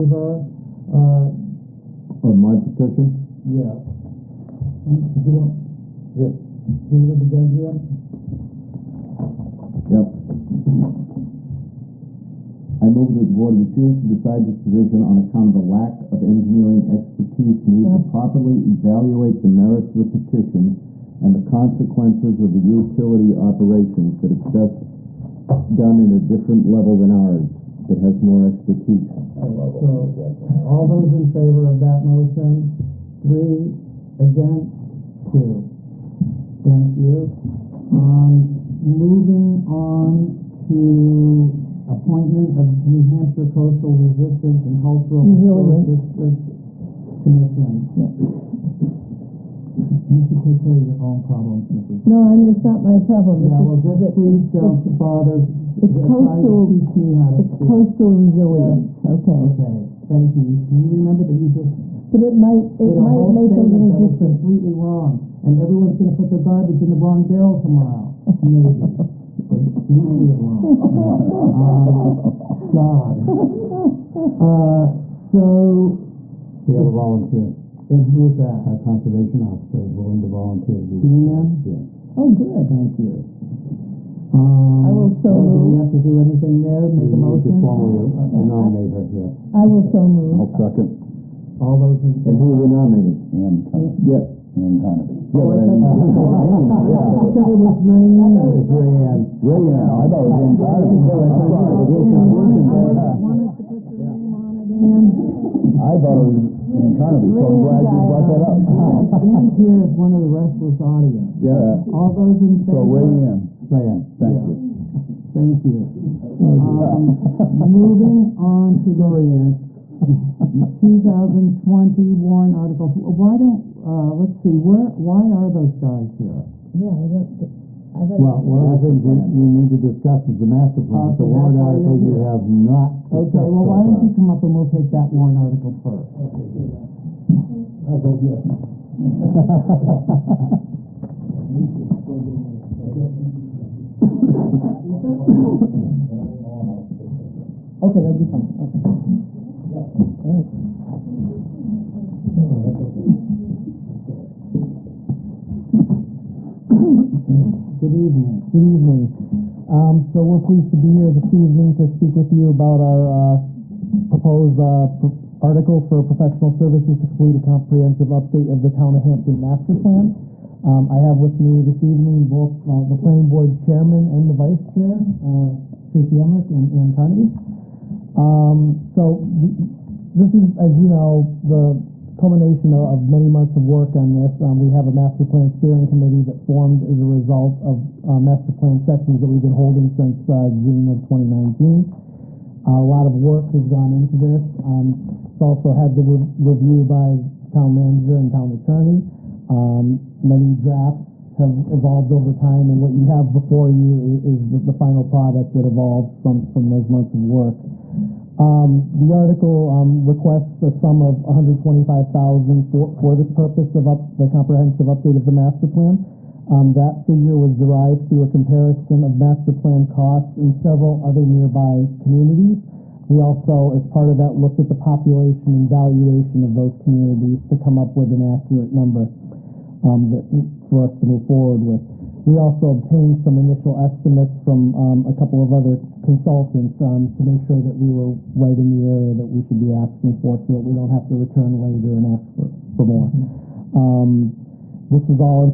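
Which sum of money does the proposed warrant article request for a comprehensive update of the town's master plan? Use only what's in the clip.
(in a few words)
$125,000.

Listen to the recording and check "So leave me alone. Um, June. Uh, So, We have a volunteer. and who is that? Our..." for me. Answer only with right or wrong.
wrong.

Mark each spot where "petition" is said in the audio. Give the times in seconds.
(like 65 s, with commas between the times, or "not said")
2 s, 20 s.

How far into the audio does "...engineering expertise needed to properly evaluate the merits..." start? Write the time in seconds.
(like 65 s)
16 s.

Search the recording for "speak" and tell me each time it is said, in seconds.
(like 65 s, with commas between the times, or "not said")
57 s, 161 s.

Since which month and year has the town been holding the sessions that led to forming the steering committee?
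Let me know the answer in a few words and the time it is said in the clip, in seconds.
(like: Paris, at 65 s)
June 2019, at 190 s.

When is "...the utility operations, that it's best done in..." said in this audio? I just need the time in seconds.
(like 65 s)
22 s.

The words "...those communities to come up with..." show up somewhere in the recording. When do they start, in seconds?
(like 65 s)
226 s.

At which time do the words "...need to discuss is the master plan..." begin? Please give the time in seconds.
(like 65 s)
129 s.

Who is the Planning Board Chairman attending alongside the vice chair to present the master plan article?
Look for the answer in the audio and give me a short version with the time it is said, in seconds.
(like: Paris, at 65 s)
Tracy Emerick, at 175 s.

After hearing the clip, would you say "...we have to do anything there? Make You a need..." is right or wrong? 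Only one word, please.
right.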